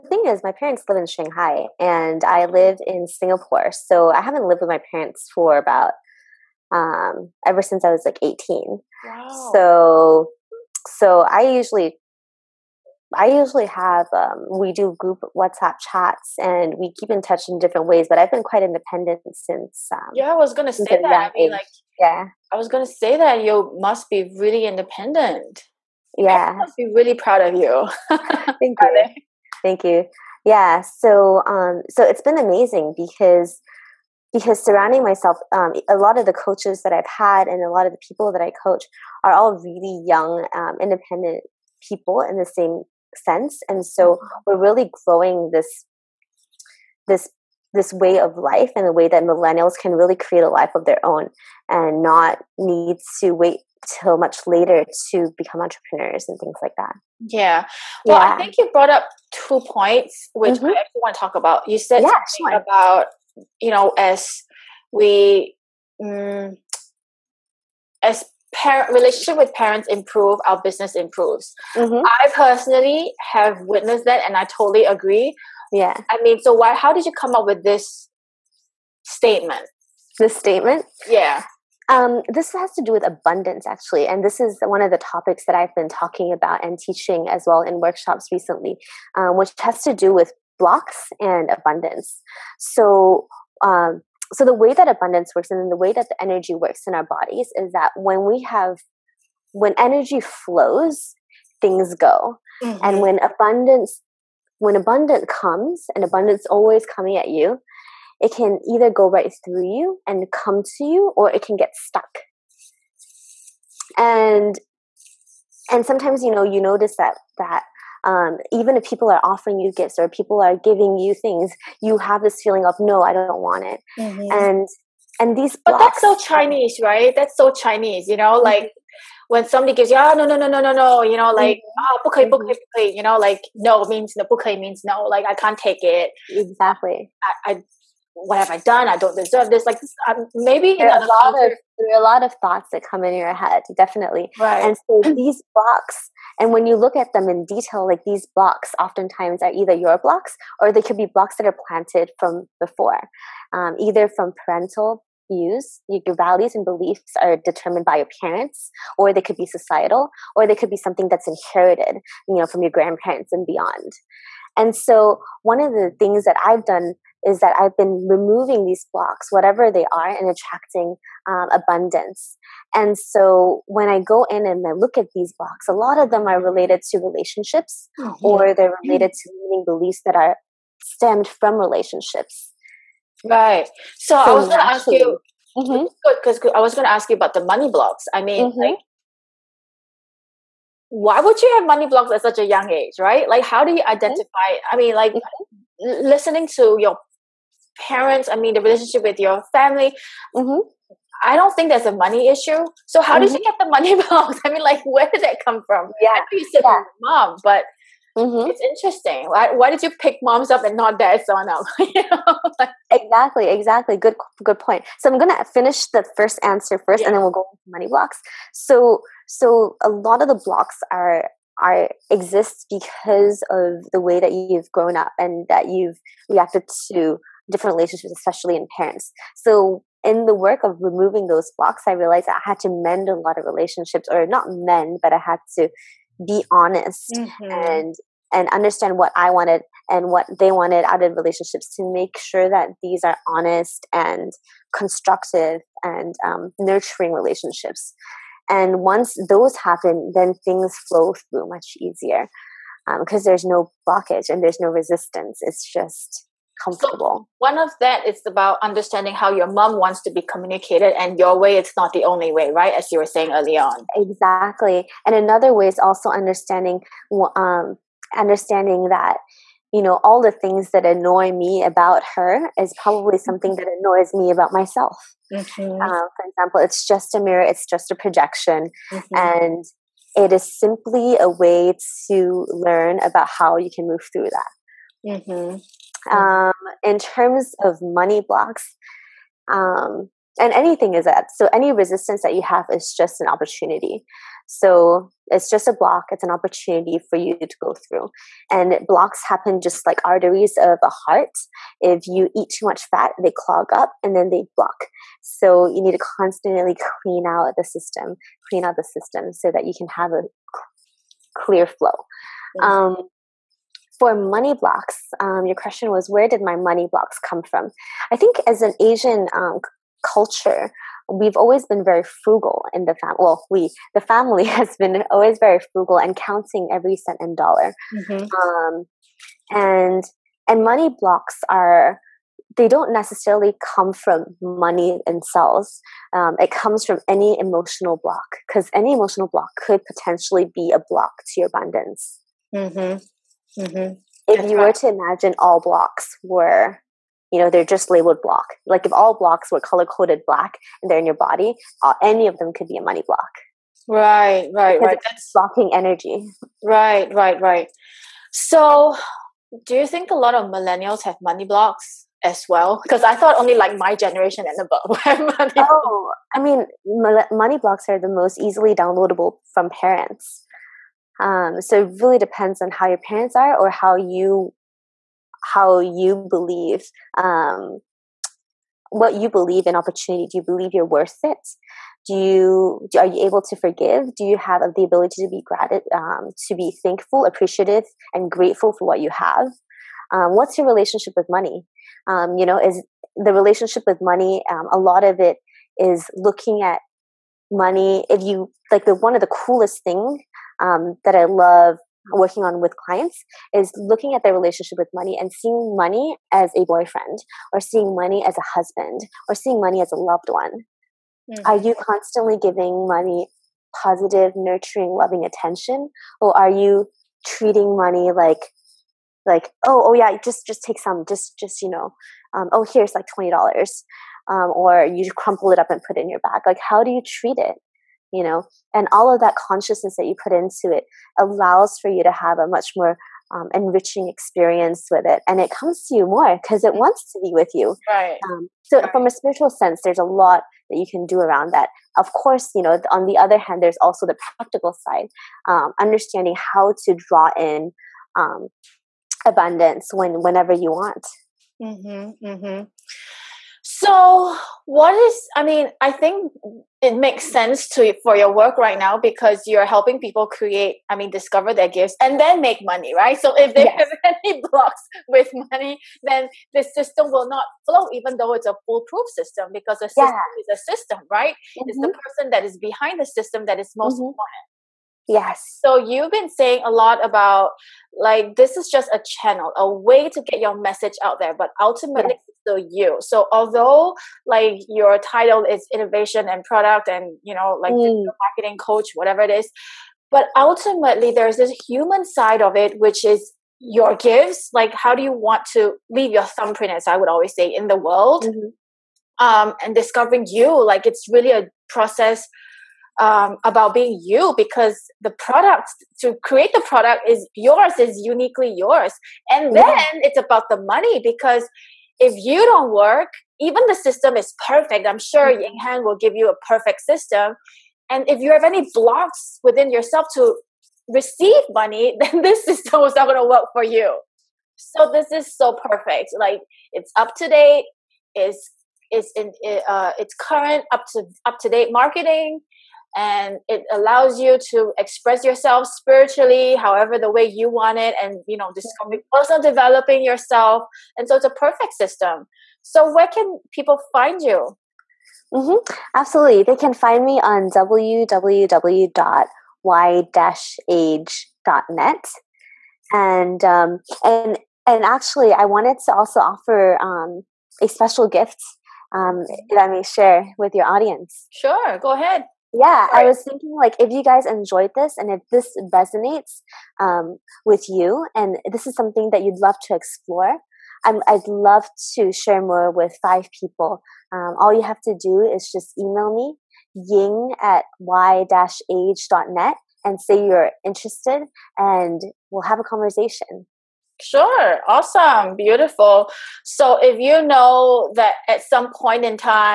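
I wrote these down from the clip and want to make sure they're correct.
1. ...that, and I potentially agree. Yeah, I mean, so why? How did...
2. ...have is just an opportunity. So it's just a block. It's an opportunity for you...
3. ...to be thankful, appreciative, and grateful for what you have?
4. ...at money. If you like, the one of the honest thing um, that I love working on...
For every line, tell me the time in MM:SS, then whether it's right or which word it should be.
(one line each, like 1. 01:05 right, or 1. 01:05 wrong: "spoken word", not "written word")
1. 01:14 wrong: "totally", not "potentially"
2. 04:52 right
3. 06:26 right
4. 06:36 wrong: "coolest", not "honest".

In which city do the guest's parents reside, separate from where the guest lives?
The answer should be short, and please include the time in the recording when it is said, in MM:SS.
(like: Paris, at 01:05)
Shanghai, at 00:01.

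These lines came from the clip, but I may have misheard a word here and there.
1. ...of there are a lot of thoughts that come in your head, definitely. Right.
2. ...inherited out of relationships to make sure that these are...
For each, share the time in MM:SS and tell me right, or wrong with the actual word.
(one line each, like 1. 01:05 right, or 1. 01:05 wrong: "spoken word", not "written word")
1. 02:21 right
2. 04:00 wrong: "wanted", not "inherited".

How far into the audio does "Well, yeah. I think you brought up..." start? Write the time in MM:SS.
00:58.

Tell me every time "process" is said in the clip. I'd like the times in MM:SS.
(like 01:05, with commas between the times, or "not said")
08:21.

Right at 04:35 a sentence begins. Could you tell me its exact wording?
Uh, for example it's just a mirror it's just a projection mm-hmm.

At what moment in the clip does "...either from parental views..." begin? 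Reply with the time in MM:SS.
02:33.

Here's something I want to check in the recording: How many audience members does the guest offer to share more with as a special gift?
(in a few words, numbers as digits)
5.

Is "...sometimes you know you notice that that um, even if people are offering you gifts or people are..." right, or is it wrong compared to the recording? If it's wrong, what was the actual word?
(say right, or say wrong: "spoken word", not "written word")
right.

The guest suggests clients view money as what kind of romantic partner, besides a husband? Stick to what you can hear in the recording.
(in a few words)
A boyfriend.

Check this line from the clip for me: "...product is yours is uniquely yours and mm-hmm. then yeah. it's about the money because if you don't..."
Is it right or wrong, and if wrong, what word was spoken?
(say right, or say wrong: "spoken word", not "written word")
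right.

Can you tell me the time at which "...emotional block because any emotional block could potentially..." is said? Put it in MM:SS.
05:37.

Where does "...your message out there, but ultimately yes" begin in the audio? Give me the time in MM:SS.
08:00.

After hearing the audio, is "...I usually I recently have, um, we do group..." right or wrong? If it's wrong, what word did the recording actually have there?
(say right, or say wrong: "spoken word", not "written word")
wrong: "usually", not "recently".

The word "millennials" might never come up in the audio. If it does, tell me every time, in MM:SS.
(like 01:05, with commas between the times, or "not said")
00:49, 06:00.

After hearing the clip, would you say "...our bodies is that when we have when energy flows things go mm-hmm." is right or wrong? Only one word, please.
right.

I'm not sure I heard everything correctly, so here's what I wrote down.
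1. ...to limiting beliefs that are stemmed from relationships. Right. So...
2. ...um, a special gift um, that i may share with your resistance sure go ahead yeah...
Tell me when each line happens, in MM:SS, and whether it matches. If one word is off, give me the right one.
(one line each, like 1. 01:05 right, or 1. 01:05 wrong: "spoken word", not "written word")
1. 02:59 right
2. 09:16 wrong: "audience", not "resistance".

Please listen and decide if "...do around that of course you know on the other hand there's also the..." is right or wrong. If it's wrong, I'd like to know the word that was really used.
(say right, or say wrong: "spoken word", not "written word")
right.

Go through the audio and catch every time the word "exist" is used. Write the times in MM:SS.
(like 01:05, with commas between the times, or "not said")
03:42.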